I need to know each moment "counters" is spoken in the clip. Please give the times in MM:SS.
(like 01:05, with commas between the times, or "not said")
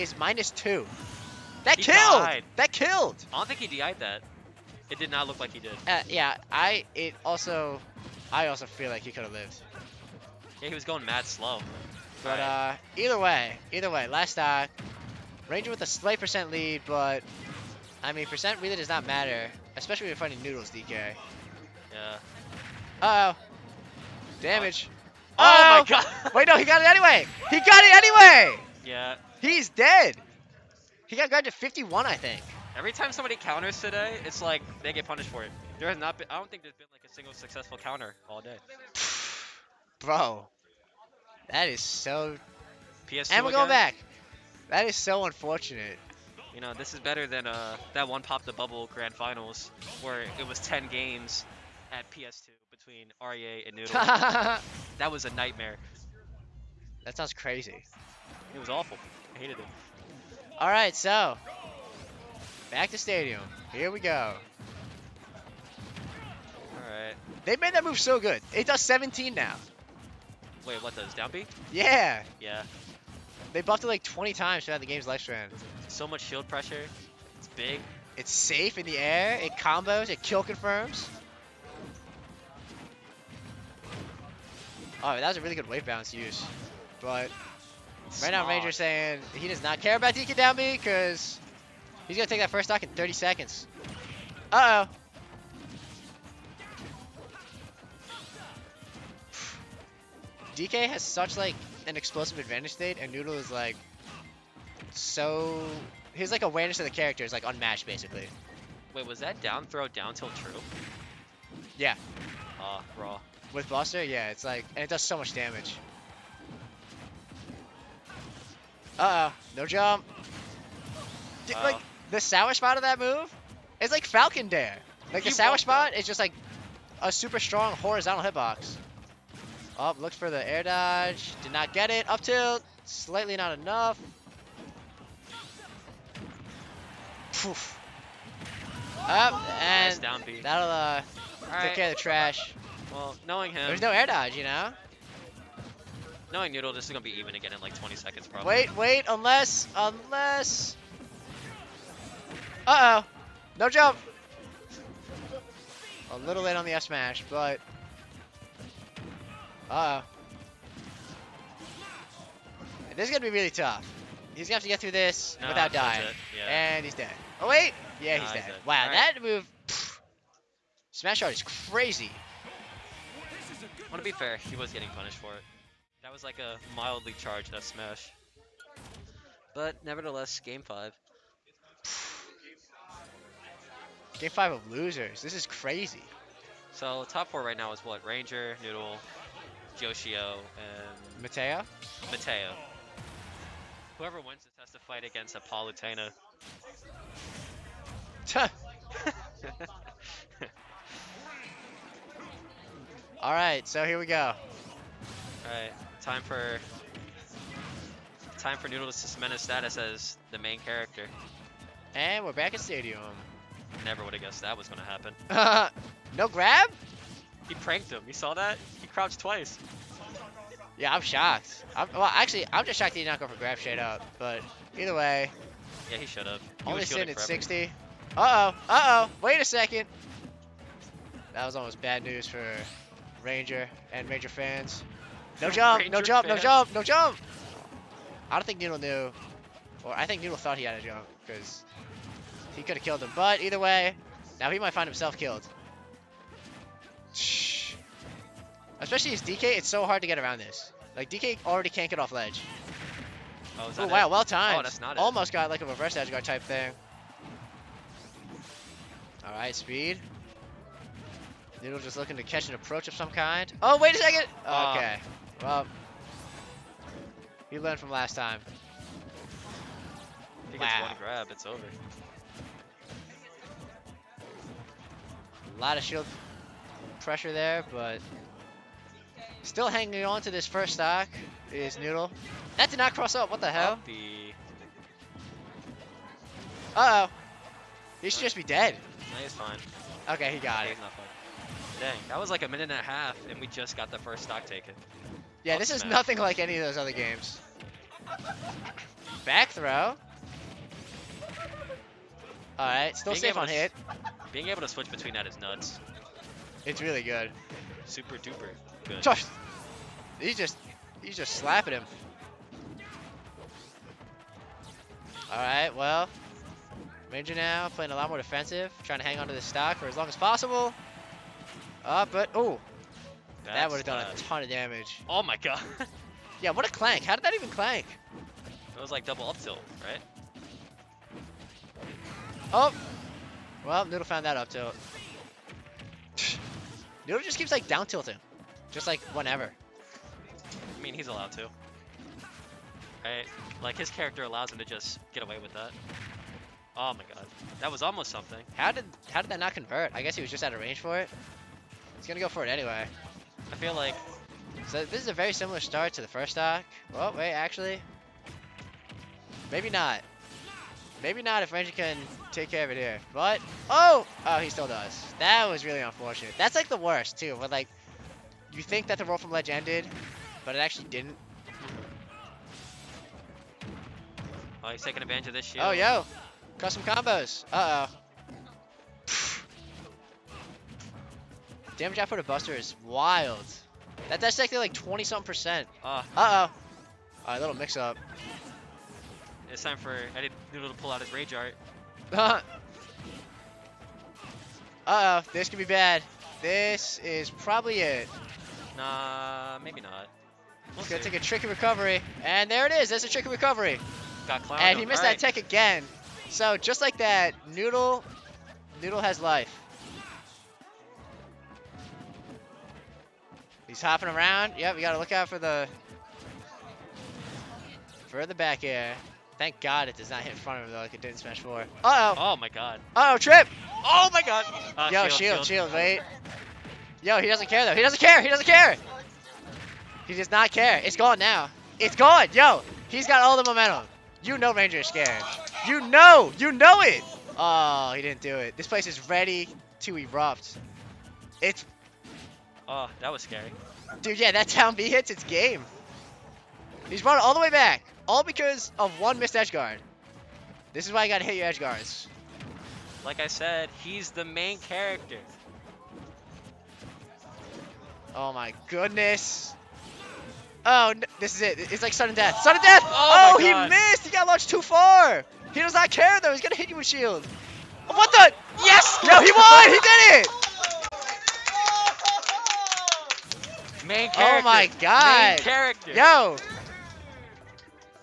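00:33, 00:37.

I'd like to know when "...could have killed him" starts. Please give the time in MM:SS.
04:02.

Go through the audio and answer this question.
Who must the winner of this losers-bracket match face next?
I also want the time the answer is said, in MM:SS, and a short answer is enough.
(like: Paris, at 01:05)
Apollo Tana, at 03:15.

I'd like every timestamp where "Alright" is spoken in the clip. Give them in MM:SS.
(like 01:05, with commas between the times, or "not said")
04:19, 06:27.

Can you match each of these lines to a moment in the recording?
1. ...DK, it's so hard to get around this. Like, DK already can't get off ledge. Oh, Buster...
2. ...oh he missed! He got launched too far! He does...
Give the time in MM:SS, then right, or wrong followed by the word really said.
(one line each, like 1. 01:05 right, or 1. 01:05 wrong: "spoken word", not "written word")
1. 04:09 wrong: "Ooh", not "Buster"
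2. 07:43 right.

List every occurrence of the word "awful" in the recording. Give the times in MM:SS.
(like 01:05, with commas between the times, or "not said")
00:58.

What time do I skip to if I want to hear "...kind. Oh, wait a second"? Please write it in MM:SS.
04:23.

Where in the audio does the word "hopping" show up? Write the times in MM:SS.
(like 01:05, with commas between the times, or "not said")
06:53.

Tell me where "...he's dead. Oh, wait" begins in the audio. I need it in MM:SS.
02:46.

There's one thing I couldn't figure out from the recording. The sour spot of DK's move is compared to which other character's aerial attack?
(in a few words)
Falcon Dair.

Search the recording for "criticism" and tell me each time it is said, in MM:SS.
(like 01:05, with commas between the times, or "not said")
not said.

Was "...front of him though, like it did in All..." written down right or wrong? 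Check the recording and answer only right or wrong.
wrong.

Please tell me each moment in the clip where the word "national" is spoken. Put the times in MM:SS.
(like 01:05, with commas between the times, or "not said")
not said.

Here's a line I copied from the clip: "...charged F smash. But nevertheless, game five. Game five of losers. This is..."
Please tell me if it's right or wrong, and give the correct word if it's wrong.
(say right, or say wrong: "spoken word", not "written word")
right.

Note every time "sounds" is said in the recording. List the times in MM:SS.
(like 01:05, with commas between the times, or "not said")
00:57.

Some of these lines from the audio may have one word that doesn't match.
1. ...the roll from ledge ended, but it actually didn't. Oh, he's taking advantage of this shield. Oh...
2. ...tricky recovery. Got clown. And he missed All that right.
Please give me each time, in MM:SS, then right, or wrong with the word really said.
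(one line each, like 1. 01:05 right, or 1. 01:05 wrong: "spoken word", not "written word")
1. 06:08 right
2. 06:43 right.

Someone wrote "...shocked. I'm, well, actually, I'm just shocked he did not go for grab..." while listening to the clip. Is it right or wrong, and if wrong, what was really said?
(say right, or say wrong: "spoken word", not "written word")
right.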